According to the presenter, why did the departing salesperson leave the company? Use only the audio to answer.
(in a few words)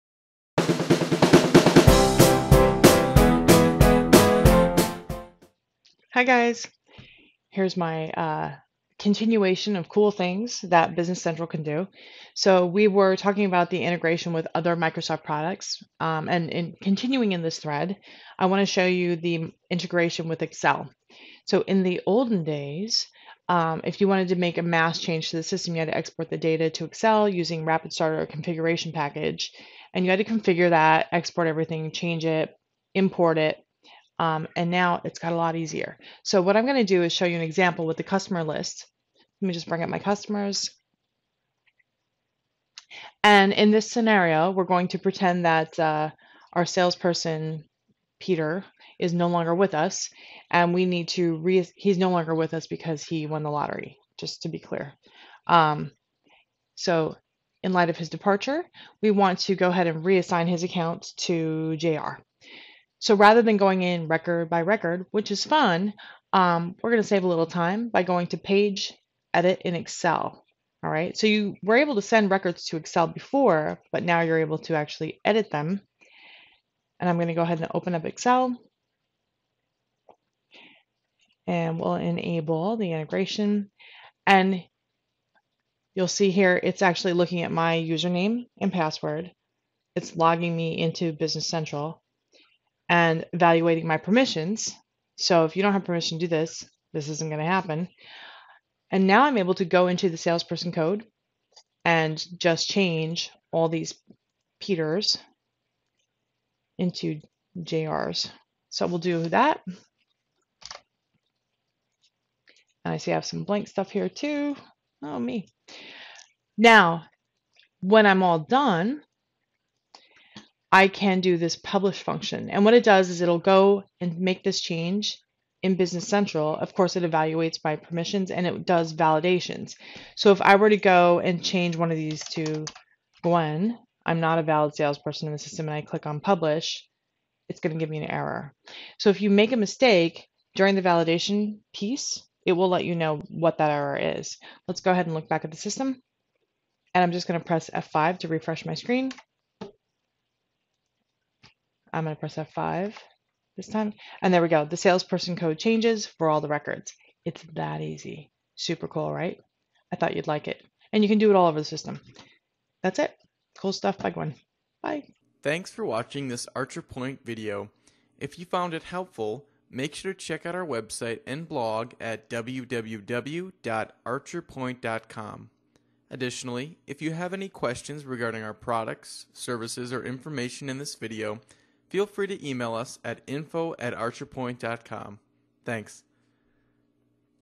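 He won the lottery.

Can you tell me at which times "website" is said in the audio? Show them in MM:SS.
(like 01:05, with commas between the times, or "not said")
02:50.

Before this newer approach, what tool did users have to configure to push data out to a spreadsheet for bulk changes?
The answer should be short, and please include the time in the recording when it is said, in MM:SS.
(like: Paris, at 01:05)
Rapid Starter configuration package, at 00:27.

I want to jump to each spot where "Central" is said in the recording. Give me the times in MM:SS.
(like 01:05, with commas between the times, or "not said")
00:11, 01:31, 02:06.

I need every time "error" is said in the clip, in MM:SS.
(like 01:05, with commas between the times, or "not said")
02:18, 02:23.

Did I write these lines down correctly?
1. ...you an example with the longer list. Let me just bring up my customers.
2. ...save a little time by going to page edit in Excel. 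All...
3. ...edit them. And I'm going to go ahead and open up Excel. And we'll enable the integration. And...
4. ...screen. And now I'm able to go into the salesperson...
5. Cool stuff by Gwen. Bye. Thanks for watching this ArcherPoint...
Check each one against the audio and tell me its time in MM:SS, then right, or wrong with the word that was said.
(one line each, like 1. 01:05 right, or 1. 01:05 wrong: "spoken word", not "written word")
1. 00:37 wrong: "customer", not "longer"
2. 01:07 right
3. 01:15 right
4. 01:37 wrong: "happen", not "screen"
5. 02:43 right.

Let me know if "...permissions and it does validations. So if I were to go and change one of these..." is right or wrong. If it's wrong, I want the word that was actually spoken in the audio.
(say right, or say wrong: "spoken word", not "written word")
right.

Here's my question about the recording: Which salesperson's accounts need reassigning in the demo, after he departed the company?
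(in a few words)
Peter.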